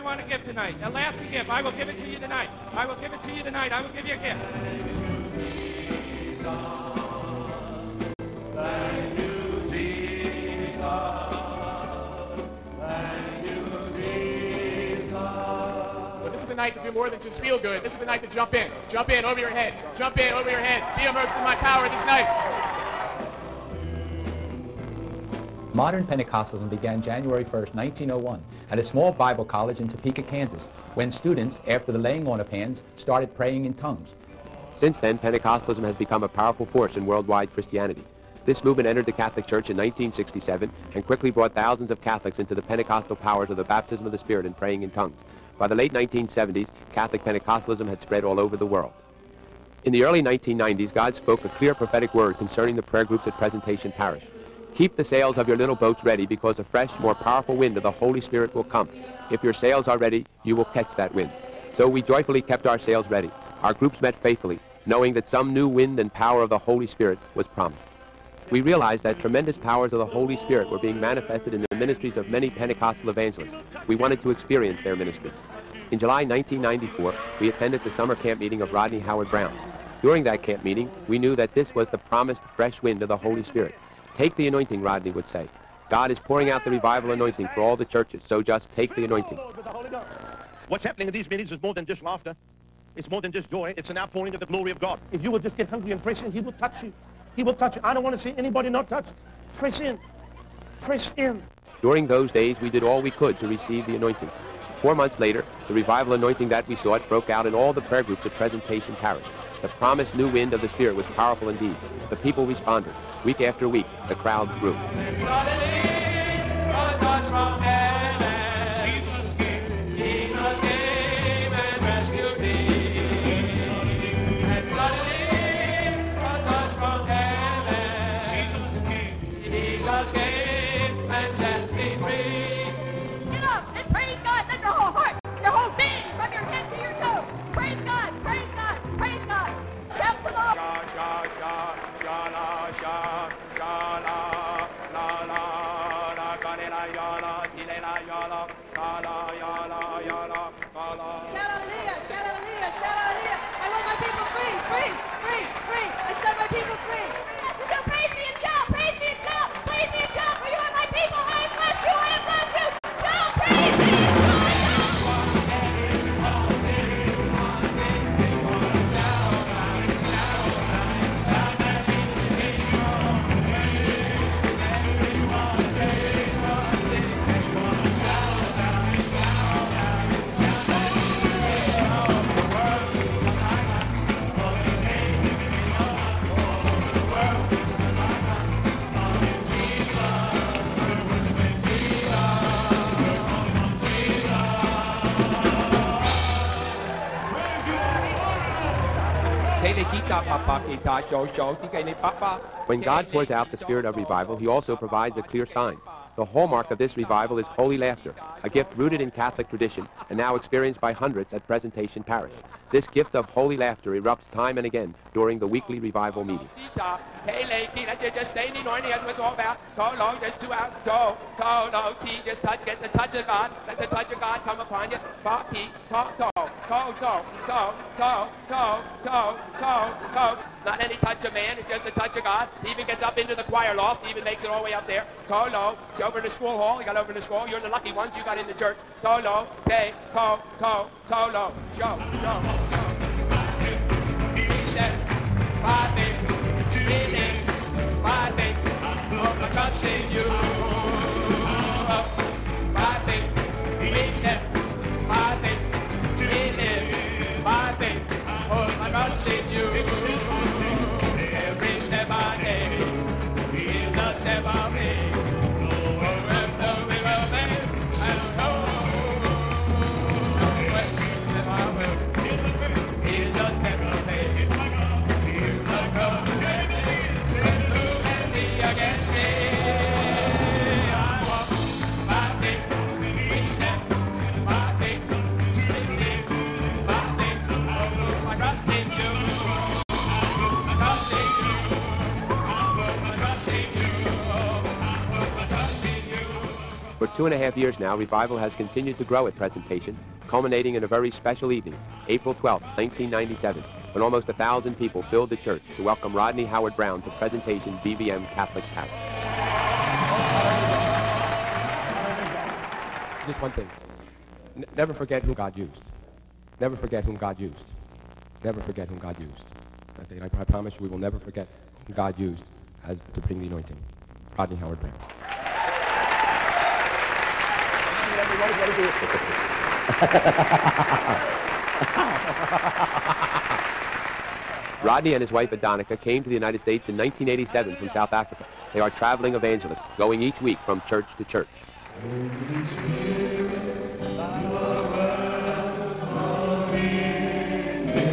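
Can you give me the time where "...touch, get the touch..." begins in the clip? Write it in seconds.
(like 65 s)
222 s.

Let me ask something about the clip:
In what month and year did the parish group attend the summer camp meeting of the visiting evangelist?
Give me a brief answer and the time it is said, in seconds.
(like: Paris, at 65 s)
July 1994, at 75 s.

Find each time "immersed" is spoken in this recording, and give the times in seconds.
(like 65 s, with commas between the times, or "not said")
21 s.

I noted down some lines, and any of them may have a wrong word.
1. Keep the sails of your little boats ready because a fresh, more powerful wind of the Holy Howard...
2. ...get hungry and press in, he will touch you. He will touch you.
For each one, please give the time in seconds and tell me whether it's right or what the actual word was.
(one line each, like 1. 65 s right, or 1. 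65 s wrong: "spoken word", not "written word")
1. 54 s wrong: "Spirit", not "Howard"
2. 95 s right.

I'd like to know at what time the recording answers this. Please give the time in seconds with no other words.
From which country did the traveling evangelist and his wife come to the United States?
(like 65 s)
337 s.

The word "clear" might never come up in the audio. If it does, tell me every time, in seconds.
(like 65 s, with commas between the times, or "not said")
51 s, 205 s.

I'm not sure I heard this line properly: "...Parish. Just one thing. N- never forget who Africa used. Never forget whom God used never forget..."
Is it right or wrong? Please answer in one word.
wrong.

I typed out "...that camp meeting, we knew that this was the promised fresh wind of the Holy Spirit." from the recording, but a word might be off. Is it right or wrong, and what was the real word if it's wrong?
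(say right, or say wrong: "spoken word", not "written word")
right.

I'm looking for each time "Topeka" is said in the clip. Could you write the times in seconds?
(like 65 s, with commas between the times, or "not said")
29 s.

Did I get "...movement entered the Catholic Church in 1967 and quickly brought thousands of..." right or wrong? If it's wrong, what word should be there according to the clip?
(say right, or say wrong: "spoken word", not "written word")
right.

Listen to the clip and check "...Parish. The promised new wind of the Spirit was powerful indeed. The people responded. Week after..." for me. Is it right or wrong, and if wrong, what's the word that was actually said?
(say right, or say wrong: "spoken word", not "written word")
right.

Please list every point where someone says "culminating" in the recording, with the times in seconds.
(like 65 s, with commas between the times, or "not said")
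300 s.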